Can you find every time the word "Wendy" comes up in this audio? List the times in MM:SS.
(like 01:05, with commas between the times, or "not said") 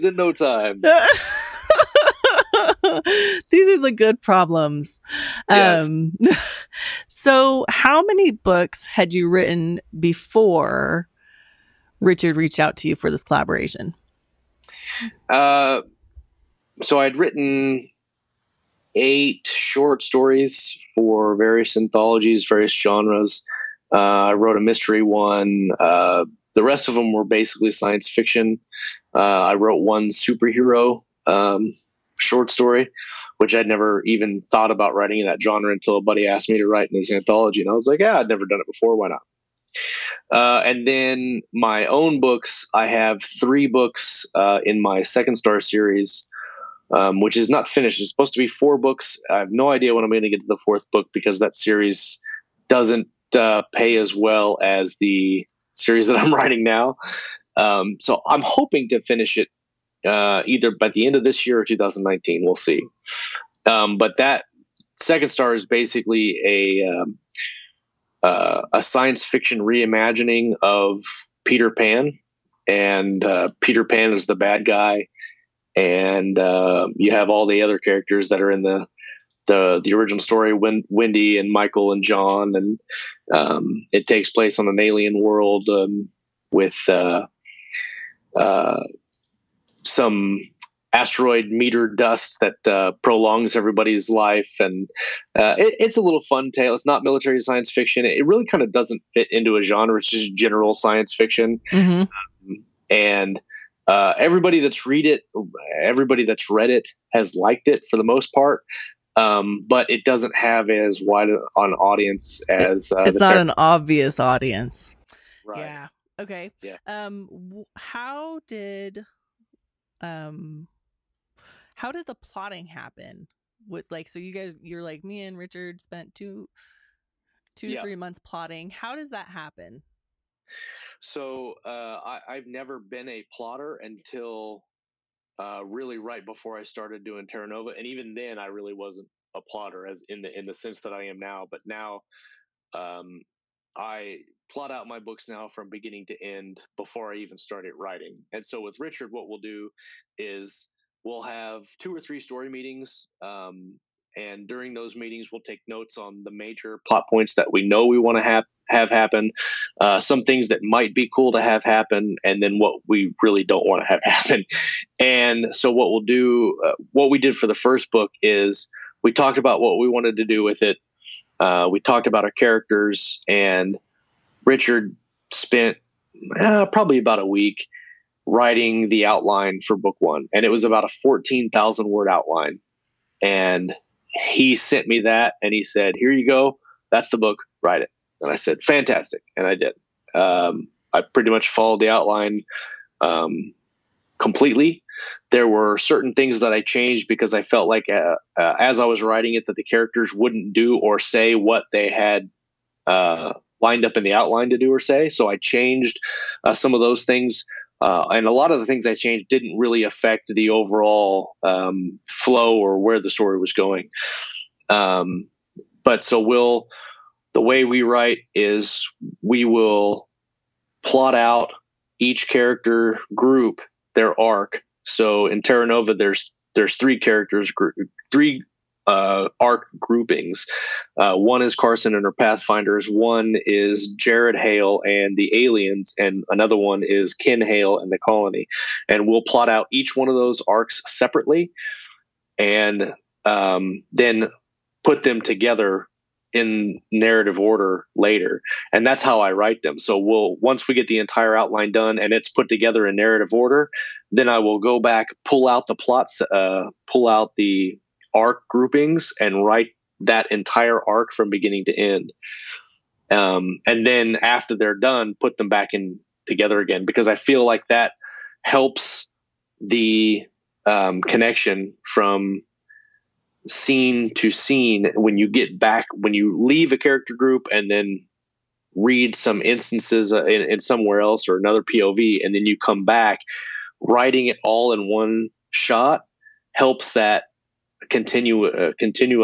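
01:20.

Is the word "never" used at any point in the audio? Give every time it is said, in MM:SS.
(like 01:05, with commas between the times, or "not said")
00:33, 00:38, 02:12.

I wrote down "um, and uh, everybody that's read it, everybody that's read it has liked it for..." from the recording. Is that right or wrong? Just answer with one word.
right.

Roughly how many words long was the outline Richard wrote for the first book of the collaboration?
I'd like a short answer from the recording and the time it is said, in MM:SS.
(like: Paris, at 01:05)
14,000, at 03:01.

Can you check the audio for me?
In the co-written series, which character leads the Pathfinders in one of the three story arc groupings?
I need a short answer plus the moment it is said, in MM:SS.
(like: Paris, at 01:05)
Carson, at 03:51.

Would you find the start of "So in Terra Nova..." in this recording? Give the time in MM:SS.
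03:44.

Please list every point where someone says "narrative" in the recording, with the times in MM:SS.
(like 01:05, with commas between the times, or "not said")
04:06, 04:12.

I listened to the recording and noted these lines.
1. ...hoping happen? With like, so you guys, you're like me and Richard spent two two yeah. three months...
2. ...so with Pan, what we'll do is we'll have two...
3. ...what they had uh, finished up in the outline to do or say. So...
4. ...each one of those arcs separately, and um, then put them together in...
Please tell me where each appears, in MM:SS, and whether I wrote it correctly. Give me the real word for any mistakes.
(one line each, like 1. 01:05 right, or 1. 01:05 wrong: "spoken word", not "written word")
1. 02:02 wrong: "plotting", not "hoping"
2. 02:28 wrong: "Richard", not "Pan"
3. 03:21 wrong: "lined", not "finished"
4. 03:59 right.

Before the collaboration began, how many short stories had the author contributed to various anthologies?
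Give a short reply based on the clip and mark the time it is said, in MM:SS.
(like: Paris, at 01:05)
8, at 00:18.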